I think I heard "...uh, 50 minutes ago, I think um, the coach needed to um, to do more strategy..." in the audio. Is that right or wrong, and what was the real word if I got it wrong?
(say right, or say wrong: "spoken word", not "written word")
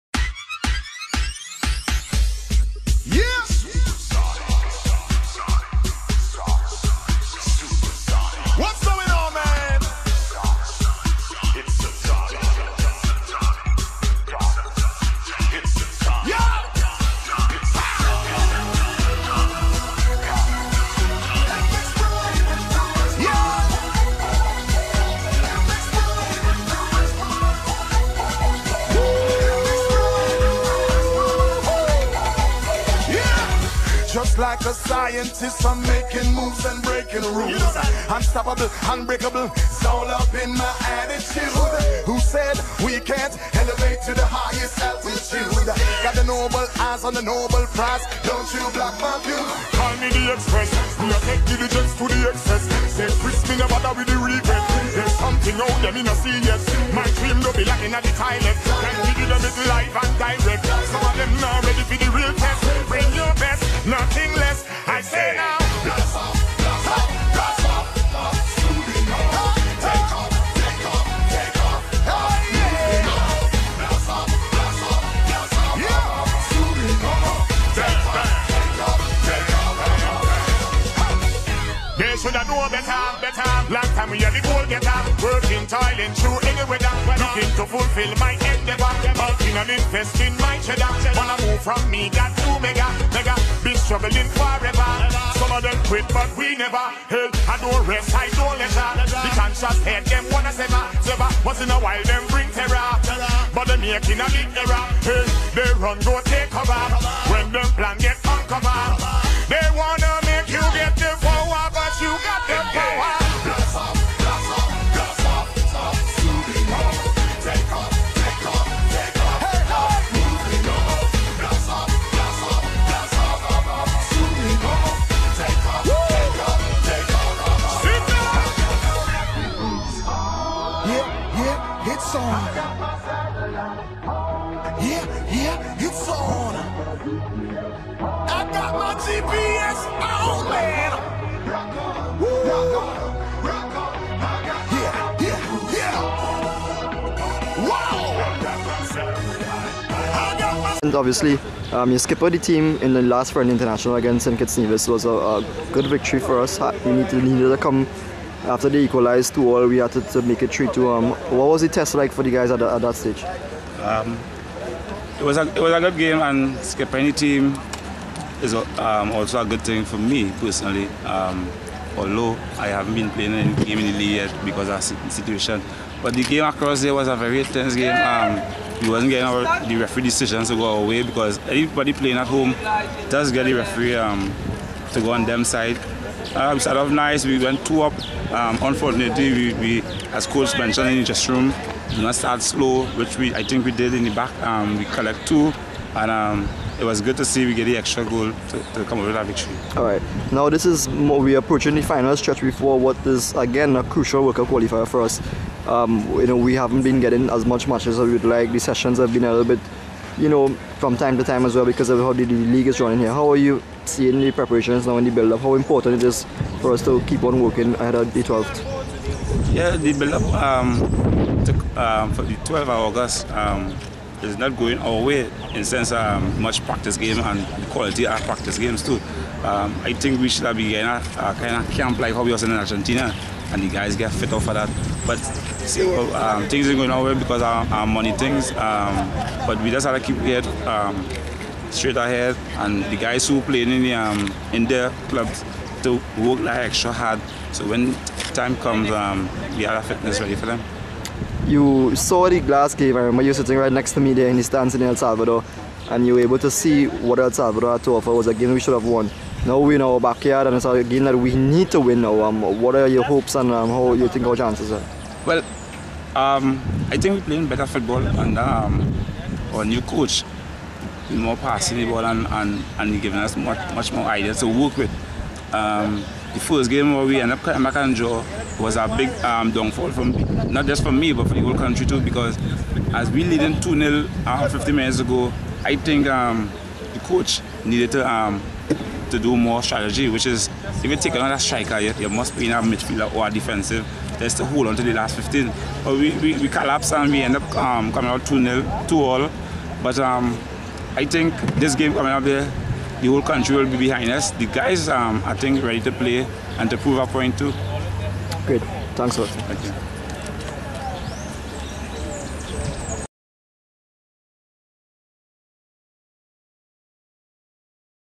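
right.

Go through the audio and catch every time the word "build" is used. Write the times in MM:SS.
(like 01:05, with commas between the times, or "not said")
03:35, 03:39.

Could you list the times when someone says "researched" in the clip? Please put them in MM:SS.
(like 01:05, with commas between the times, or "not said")
not said.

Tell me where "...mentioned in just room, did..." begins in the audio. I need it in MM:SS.
03:10.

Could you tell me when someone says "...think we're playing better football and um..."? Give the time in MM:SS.
04:26.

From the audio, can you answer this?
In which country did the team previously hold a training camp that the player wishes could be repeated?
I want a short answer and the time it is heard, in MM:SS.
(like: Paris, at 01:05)
Argentina, at 03:52.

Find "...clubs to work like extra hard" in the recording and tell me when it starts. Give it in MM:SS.
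04:05.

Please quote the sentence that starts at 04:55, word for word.
But we, we, we collapse and we end up um, coming out 2 0, 2 all.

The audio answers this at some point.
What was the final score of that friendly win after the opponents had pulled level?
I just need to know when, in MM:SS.
02:40.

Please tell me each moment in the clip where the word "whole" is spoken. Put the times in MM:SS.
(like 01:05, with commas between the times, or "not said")
04:41, 05:03.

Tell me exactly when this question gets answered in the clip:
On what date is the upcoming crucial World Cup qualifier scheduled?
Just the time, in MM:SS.
03:42.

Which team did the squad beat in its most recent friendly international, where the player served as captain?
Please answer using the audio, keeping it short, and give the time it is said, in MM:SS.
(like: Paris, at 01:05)
St. Kitts Nevis, at 02:34.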